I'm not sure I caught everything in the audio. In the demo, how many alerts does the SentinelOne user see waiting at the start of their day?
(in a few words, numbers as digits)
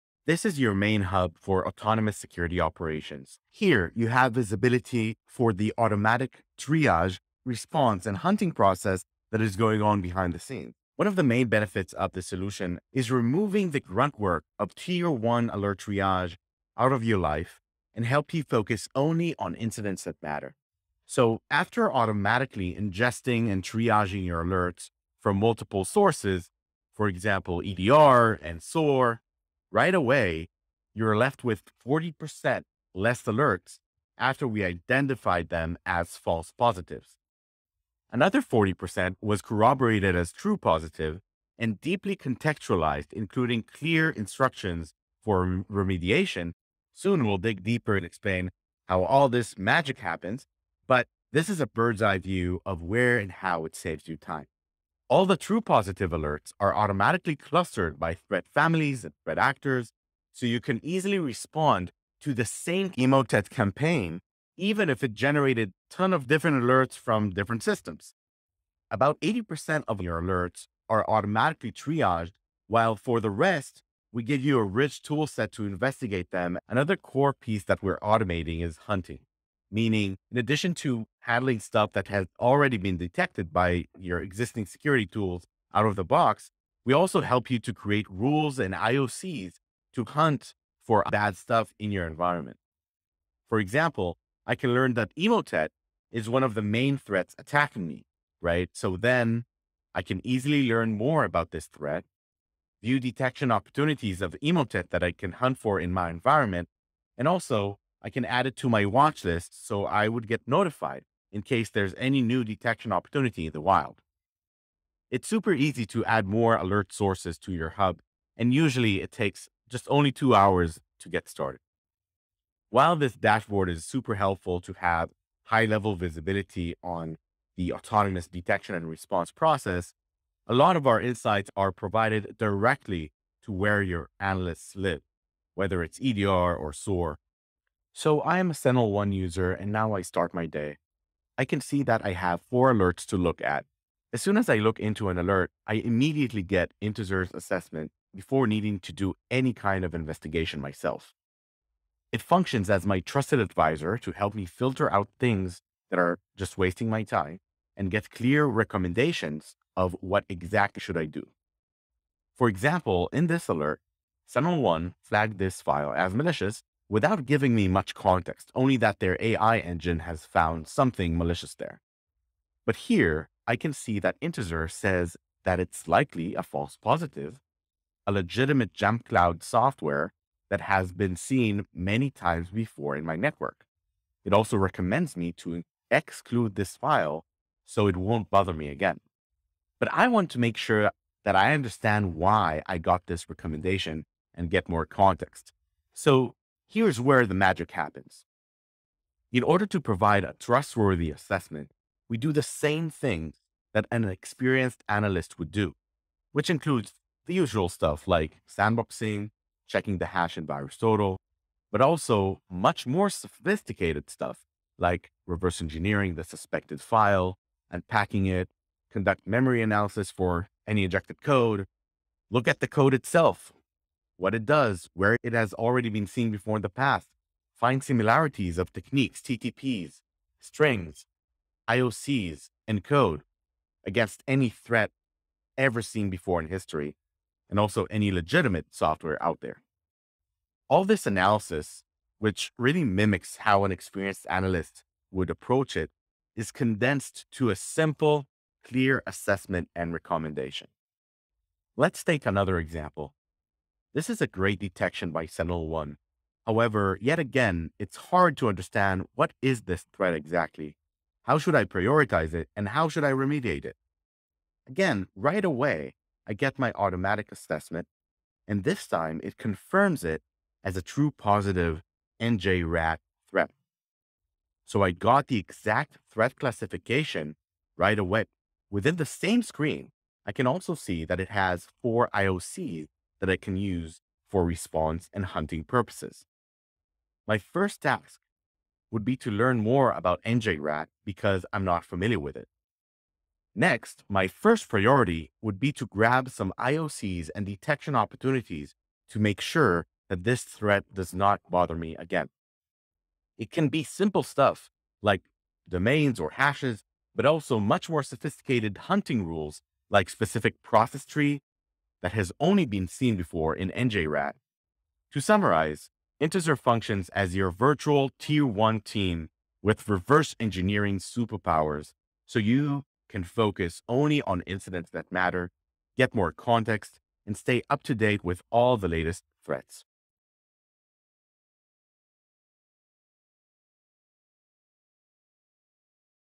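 4.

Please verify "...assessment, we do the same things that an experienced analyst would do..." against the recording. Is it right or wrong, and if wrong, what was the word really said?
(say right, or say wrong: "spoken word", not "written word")
right.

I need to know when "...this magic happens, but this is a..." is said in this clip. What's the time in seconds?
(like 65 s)
49 s.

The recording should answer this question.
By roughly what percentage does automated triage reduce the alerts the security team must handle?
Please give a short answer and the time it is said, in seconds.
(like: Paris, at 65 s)
40%, at 31 s.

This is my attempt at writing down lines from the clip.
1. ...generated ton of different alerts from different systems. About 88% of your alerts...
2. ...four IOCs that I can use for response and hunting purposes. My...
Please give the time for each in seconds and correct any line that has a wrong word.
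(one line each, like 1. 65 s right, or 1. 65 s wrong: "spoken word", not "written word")
1. 65 s wrong: "80", not "88"
2. 281 s right.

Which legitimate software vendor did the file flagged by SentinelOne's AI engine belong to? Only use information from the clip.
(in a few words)
JumpCloud.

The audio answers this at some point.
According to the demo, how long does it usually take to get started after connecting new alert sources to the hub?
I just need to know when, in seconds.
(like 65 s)
120 s.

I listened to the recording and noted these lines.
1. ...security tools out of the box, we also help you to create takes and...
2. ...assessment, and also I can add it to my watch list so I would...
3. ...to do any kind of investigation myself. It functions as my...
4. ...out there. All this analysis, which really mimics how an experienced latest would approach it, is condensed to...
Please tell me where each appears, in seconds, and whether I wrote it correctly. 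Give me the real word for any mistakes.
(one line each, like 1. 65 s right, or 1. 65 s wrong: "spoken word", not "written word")
1. 84 s wrong: "rules", not "takes"
2. 106 s wrong: "environment", not "assessment"
3. 148 s right
4. 239 s wrong: "analyst", not "latest".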